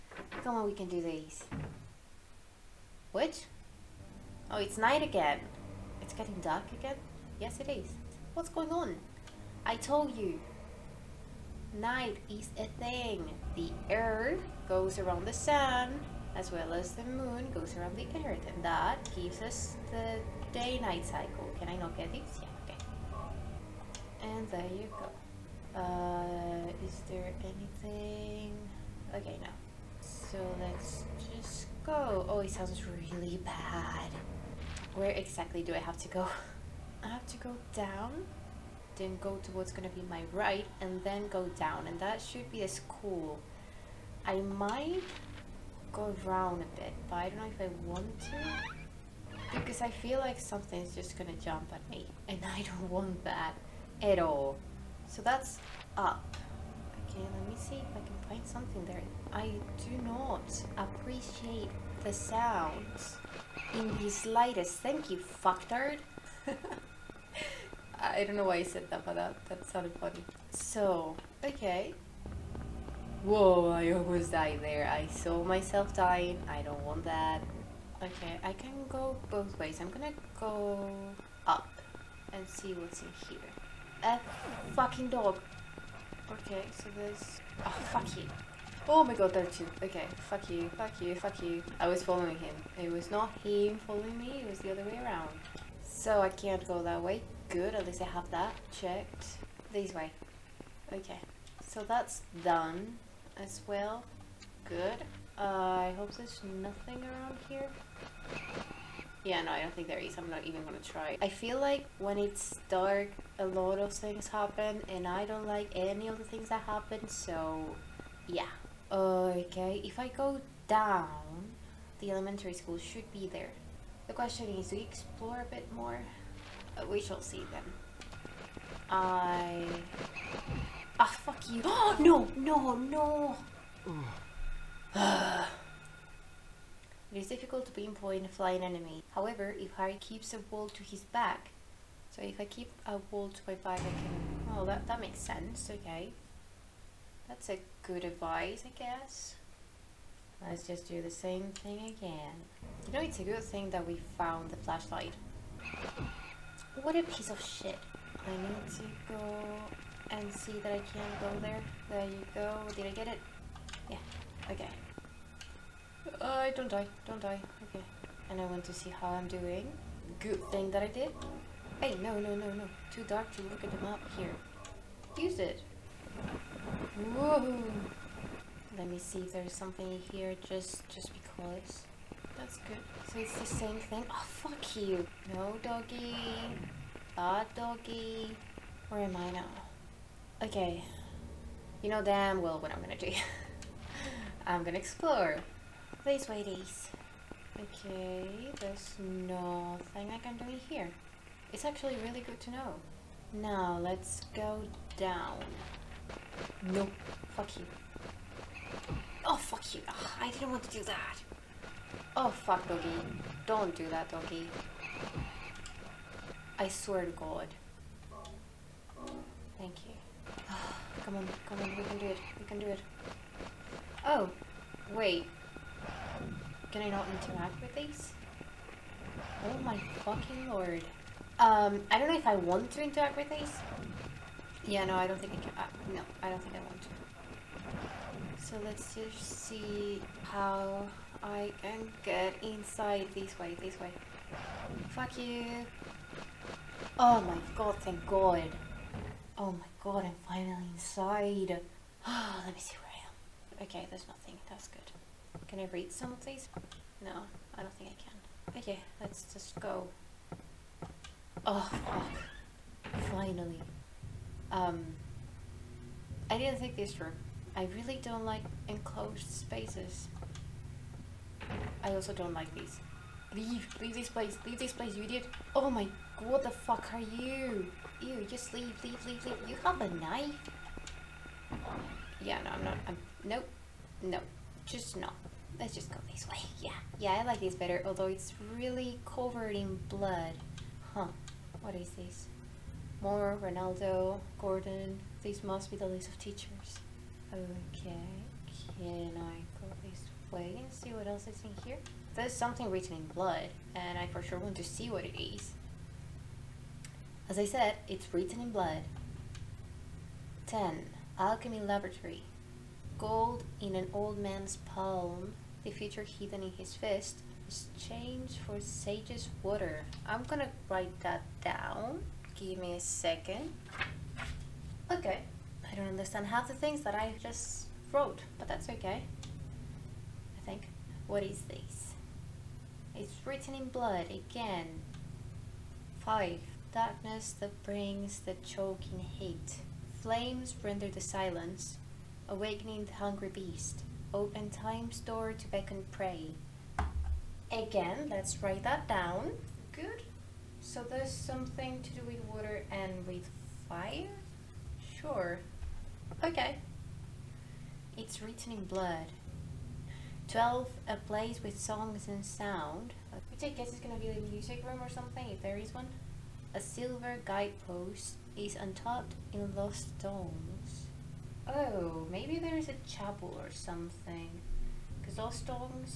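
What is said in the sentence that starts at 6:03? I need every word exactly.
I guess it's gonna be the music room or something, if there is one.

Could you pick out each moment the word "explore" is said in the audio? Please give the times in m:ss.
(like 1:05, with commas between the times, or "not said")
2:04, 3:14.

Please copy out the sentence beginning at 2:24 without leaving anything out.
Oh, that, that makes sense, okay.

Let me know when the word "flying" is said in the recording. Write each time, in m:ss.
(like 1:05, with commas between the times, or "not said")
2:18.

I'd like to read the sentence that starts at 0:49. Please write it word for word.
Because I feel like something's just gonna jump at me, and I don't want that at all.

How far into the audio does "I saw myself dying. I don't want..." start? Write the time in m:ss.
1:14.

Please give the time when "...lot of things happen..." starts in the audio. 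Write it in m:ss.
1:53.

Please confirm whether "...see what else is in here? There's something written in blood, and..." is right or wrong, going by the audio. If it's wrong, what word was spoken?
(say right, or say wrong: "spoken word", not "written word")
right.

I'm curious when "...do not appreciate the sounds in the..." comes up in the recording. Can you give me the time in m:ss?
0:59.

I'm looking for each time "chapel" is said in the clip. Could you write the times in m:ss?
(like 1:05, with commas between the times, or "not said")
6:12.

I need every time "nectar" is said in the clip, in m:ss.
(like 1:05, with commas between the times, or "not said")
not said.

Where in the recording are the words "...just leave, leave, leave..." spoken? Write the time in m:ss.
4:38.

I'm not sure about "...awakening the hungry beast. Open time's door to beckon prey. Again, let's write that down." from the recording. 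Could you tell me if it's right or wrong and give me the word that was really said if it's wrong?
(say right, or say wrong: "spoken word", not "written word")
right.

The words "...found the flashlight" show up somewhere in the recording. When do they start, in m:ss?
2:34.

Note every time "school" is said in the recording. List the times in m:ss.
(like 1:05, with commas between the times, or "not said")
0:42, 2:02.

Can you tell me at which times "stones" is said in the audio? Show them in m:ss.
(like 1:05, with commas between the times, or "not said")
6:09, 6:15.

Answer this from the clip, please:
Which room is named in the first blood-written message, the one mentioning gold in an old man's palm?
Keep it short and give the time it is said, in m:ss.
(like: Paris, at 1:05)
Alchemy Laboratory, at 5:11.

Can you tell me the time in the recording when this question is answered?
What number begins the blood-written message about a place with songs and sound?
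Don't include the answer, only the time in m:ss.
6:00.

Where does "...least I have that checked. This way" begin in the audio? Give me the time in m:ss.
1:37.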